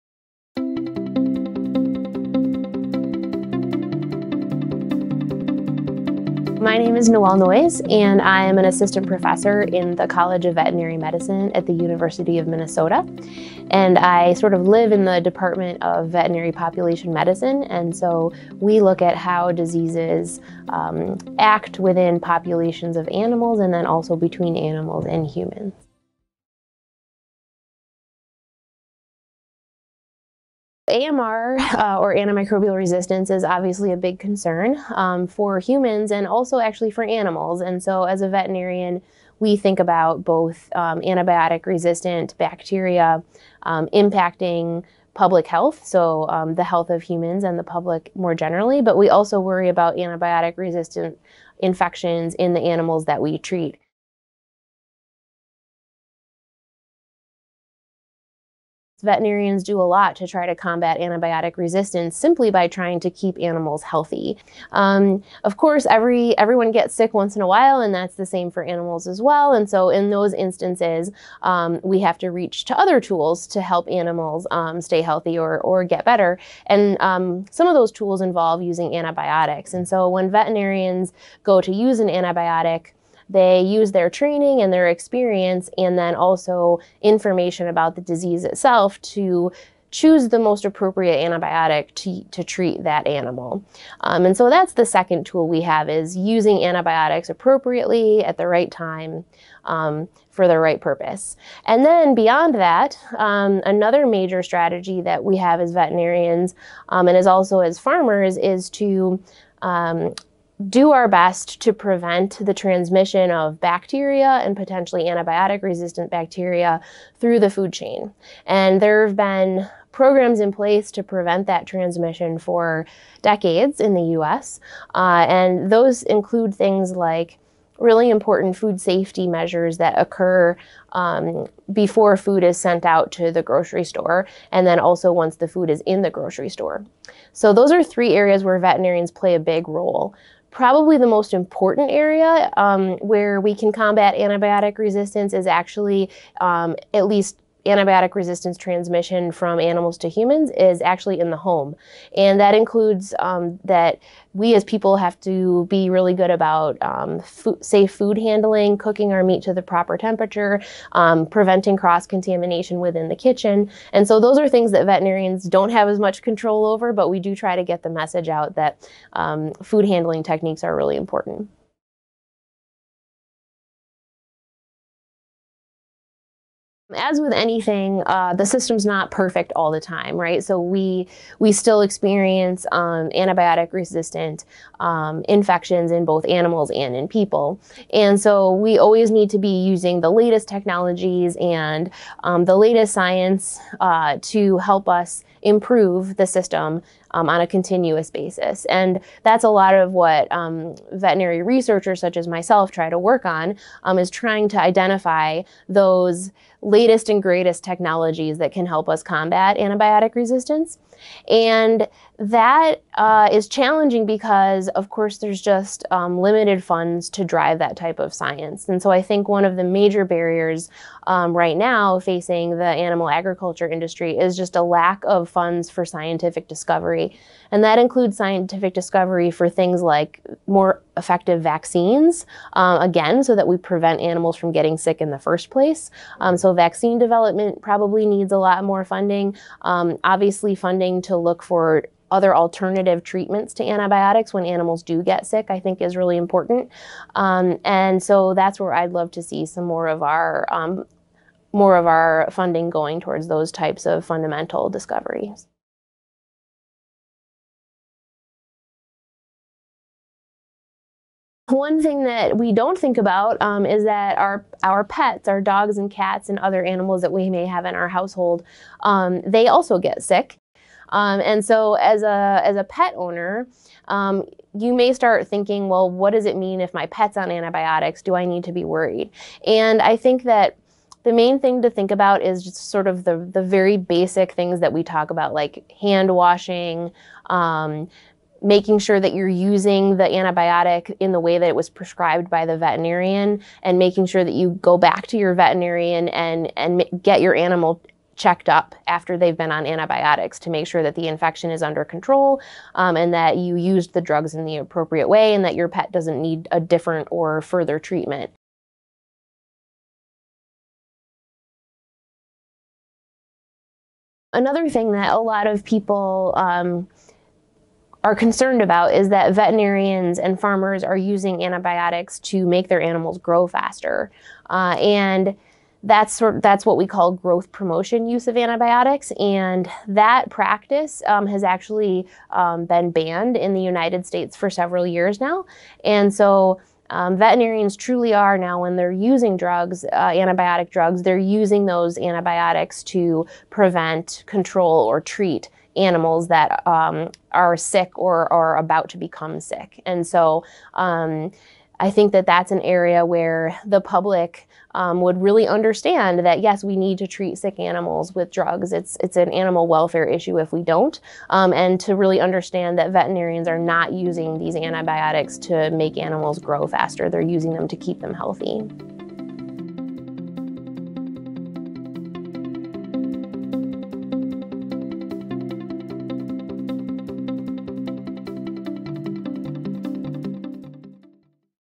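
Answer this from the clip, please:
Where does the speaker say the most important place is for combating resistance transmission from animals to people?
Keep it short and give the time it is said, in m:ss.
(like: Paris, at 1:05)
the home, at 2:31.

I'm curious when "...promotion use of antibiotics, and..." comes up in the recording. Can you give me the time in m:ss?
5:27.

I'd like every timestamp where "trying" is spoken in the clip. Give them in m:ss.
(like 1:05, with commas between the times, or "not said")
1:02, 3:24.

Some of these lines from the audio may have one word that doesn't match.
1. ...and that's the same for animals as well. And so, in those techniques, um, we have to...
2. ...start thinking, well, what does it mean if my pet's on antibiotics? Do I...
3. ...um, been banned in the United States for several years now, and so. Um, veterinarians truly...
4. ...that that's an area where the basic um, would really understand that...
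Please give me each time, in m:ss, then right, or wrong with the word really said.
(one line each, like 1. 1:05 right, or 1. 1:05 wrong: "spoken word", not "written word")
1. 1:07 wrong: "instances", not "techniques"
2. 4:34 right
3. 5:32 right
4. 5:52 wrong: "public", not "basic".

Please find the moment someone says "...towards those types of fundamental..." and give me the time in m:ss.
4:13.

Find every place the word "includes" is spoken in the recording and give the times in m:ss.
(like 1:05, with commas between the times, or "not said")
2:06, 2:32, 3:47.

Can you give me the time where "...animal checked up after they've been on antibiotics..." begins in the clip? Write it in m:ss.
4:57.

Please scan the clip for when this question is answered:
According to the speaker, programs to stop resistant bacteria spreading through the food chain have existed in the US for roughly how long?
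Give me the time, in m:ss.
2:03.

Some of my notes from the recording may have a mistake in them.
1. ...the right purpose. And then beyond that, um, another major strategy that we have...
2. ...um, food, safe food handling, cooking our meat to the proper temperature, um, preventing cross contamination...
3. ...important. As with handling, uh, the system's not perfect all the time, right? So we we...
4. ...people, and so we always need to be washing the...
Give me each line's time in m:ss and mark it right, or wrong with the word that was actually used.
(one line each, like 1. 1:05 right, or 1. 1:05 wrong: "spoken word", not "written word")
1. 1:40 right
2. 2:36 right
3. 2:50 wrong: "anything", not "handling"
4. 3:07 wrong: "using", not "washing".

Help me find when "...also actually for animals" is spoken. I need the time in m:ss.
0:36.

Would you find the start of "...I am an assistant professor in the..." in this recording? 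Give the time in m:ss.
0:08.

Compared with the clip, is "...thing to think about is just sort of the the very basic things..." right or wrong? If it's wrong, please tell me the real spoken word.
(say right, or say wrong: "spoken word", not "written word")
right.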